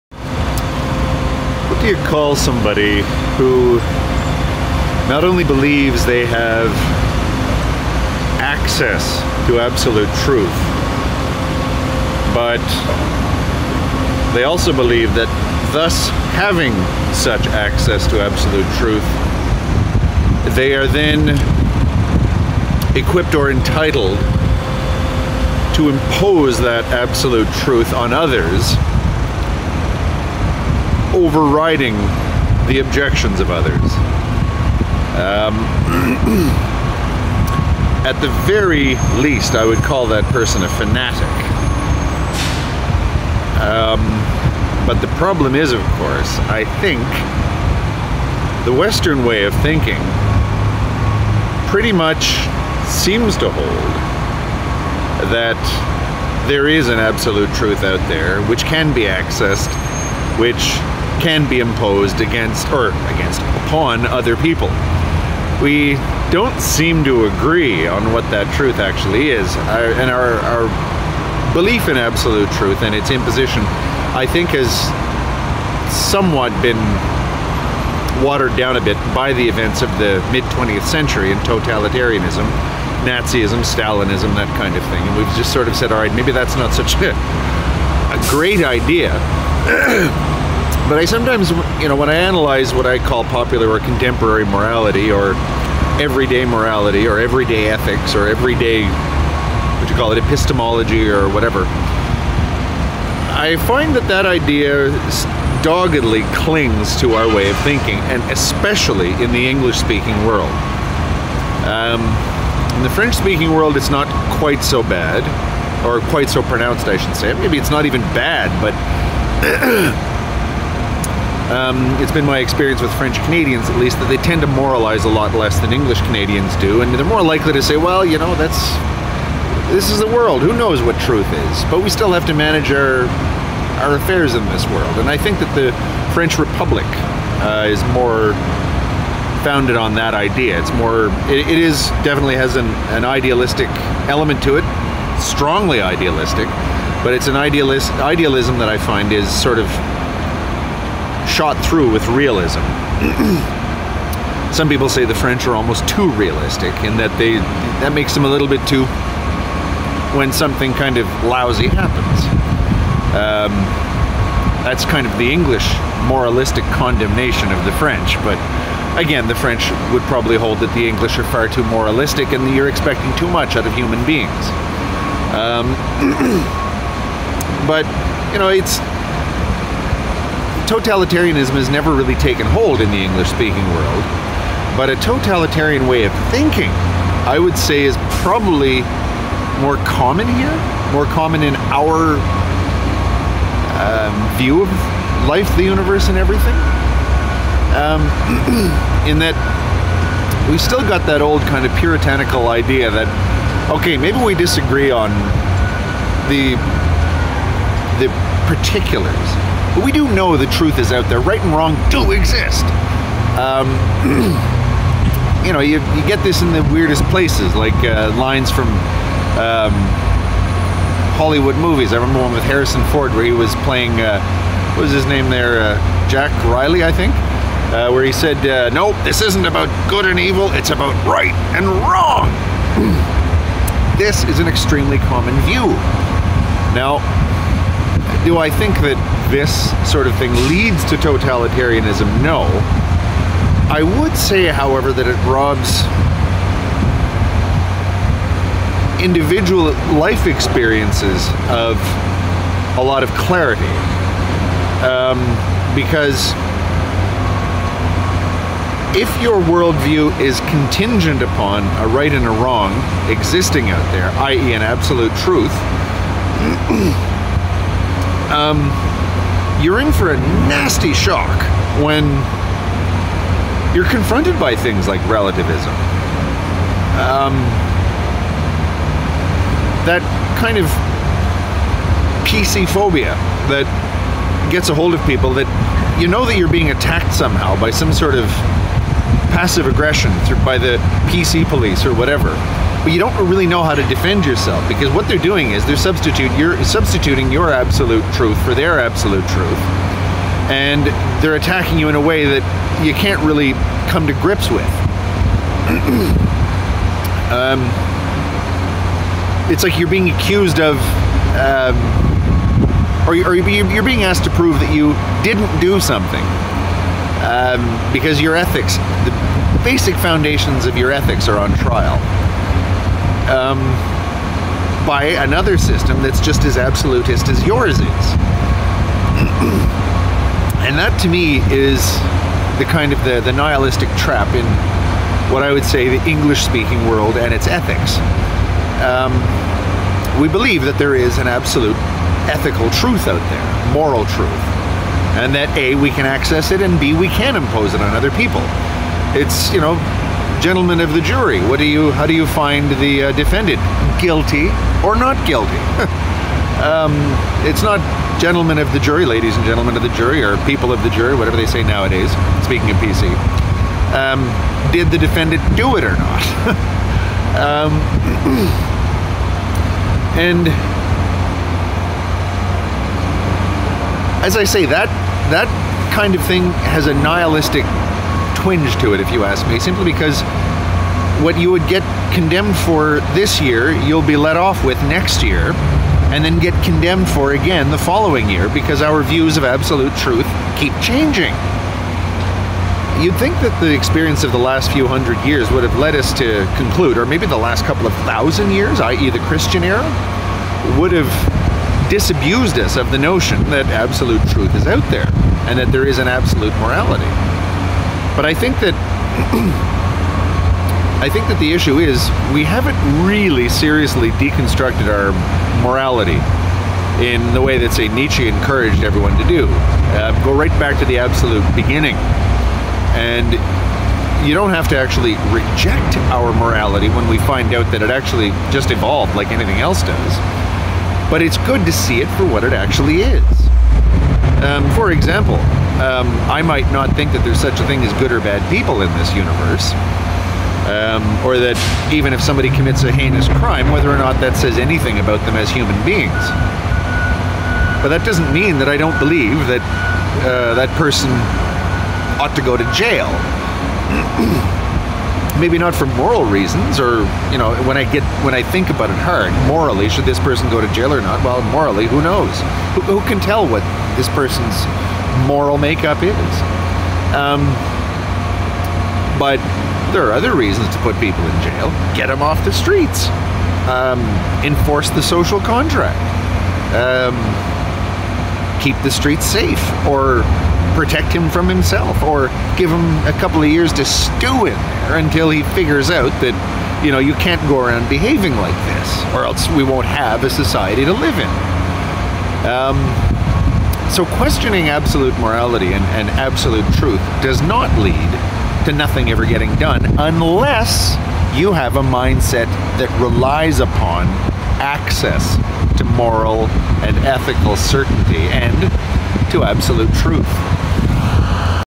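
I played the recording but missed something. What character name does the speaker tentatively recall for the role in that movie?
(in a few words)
Jack Riley.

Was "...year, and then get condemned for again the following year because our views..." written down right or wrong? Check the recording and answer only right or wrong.
right.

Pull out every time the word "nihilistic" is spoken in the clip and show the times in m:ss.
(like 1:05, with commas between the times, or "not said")
5:33, 6:16.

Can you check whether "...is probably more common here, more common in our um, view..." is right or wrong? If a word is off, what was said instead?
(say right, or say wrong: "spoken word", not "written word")
right.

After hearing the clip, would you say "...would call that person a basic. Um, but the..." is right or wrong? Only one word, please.
wrong.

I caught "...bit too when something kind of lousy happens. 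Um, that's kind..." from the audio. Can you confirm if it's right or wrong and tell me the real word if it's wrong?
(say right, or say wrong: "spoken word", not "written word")
right.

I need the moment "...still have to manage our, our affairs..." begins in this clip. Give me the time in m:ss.
2:11.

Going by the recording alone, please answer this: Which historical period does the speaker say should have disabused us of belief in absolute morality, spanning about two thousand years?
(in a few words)
the Christian era.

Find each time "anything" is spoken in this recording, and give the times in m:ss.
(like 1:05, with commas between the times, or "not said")
7:09, 7:24.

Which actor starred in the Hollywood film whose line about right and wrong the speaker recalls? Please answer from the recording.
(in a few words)
Harrison Ford.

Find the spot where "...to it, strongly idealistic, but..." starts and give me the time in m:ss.
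2:24.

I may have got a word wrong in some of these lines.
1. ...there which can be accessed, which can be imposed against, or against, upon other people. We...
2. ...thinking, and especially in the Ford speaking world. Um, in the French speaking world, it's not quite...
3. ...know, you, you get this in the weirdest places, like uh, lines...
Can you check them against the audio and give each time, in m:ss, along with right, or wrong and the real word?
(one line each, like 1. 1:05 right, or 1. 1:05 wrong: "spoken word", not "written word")
1. 0:58 right
2. 1:47 wrong: "English", not "Ford"
3. 3:35 right.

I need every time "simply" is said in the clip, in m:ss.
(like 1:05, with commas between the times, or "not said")
6:19.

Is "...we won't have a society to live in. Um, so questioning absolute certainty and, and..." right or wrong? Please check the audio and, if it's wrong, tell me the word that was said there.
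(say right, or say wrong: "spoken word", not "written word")
wrong: "morality", not "certainty".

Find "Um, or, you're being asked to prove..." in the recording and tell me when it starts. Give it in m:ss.
5:11.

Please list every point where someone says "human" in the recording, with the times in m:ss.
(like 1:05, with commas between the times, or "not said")
2:53, 7:25.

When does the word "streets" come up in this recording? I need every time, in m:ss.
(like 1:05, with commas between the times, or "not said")
7:52, 7:58.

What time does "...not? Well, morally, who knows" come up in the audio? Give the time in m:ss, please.
7:41.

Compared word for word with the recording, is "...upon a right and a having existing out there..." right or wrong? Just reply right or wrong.
wrong.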